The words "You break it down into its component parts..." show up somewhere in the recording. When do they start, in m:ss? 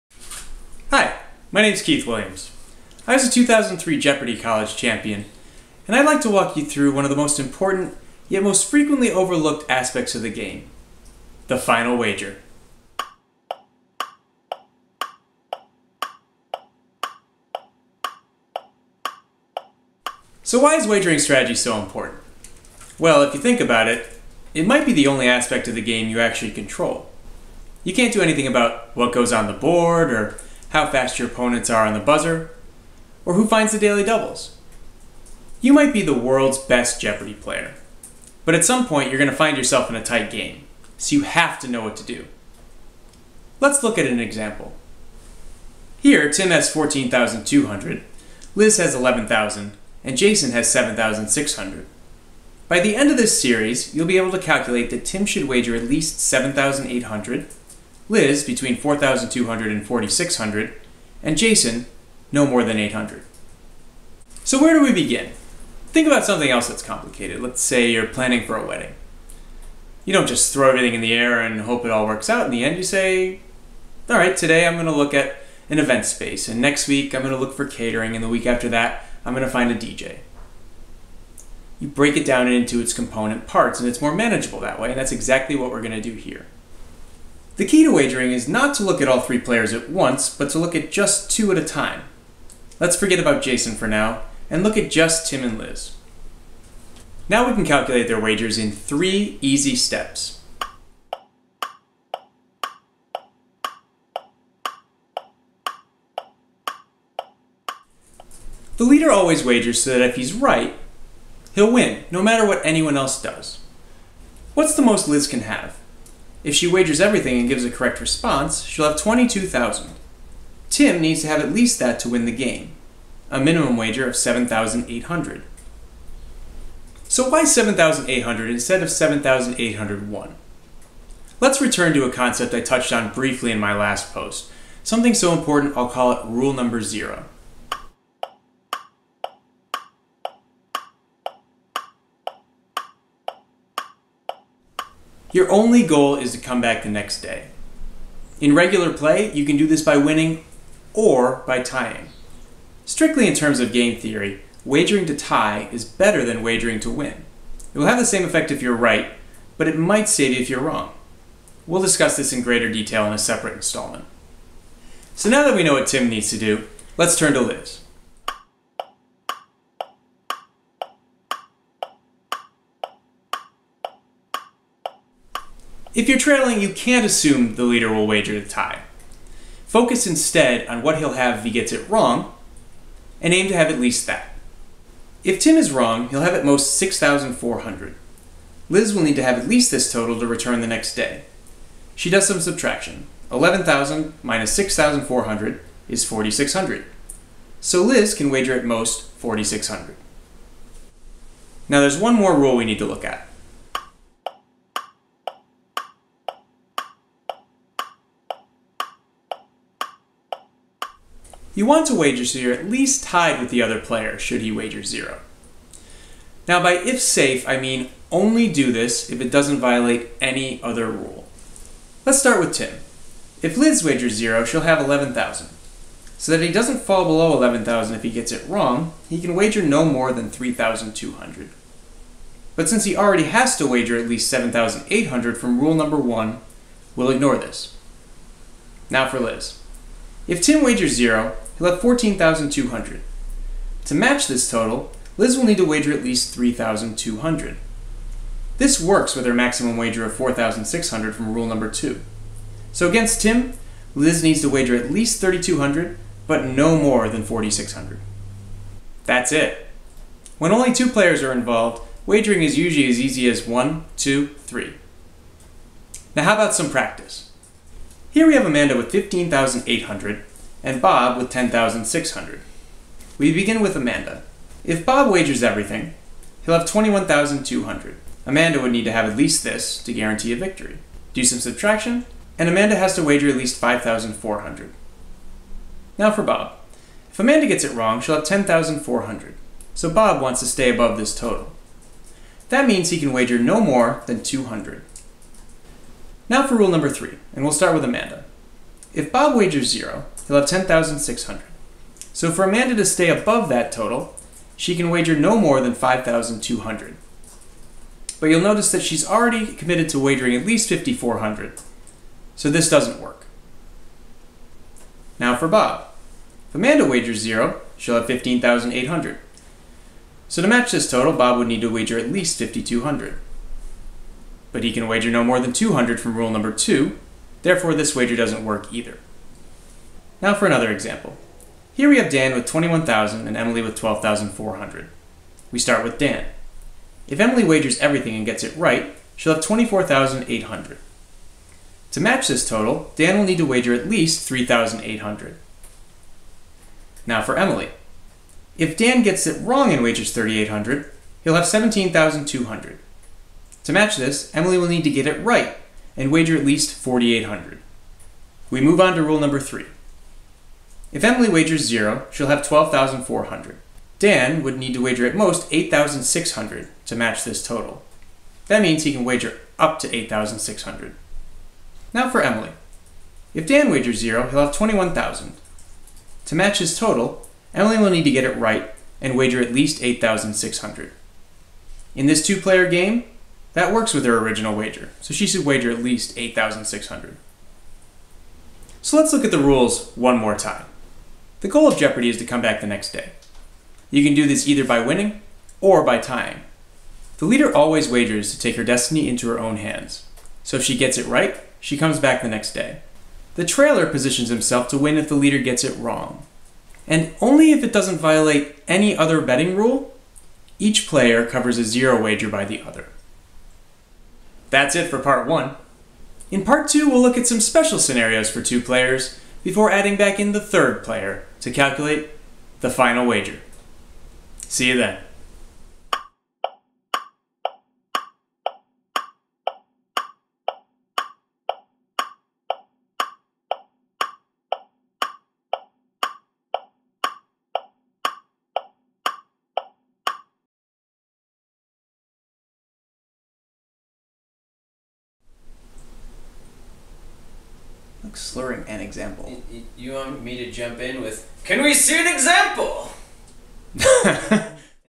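1:21.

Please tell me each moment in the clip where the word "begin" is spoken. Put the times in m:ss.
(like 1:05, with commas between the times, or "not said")
1:04, 4:33.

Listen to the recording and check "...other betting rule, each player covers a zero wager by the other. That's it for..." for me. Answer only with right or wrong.
right.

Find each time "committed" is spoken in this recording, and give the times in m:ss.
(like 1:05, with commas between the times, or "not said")
5:09.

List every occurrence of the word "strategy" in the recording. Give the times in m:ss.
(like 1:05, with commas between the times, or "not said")
0:21.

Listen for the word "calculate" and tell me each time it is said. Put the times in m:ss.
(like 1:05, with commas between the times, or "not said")
0:54, 1:37, 7:01.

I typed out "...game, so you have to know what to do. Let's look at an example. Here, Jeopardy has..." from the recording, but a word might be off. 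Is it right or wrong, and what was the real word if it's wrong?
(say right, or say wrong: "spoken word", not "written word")
wrong: "Tim", not "Jeopardy".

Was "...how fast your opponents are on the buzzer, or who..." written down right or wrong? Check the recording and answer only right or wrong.
right.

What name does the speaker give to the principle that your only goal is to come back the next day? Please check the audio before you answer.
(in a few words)
Rule number zero.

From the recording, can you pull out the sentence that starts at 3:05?
If Tim is wrong, he'll have at most 6,400.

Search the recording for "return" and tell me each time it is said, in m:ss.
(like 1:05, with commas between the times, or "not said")
2:11, 3:10.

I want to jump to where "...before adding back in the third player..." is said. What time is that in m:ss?
6:59.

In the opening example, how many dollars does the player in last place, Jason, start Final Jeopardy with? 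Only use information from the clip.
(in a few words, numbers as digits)
7,600.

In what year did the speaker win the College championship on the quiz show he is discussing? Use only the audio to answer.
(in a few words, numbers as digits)
2003.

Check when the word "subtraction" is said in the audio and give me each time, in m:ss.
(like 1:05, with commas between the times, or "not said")
3:12, 4:41.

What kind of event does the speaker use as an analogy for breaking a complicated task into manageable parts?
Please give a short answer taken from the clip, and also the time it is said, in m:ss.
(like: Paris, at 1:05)
A wedding, at 1:08.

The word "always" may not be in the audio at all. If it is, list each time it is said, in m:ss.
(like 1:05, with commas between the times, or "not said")
1:49, 6:37.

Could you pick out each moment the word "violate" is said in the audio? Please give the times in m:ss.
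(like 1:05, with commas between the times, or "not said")
3:39, 6:47.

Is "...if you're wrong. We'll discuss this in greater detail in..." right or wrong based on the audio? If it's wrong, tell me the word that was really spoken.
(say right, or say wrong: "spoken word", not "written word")
right.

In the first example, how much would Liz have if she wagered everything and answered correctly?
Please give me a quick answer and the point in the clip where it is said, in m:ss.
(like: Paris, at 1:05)
22,000, at 1:58.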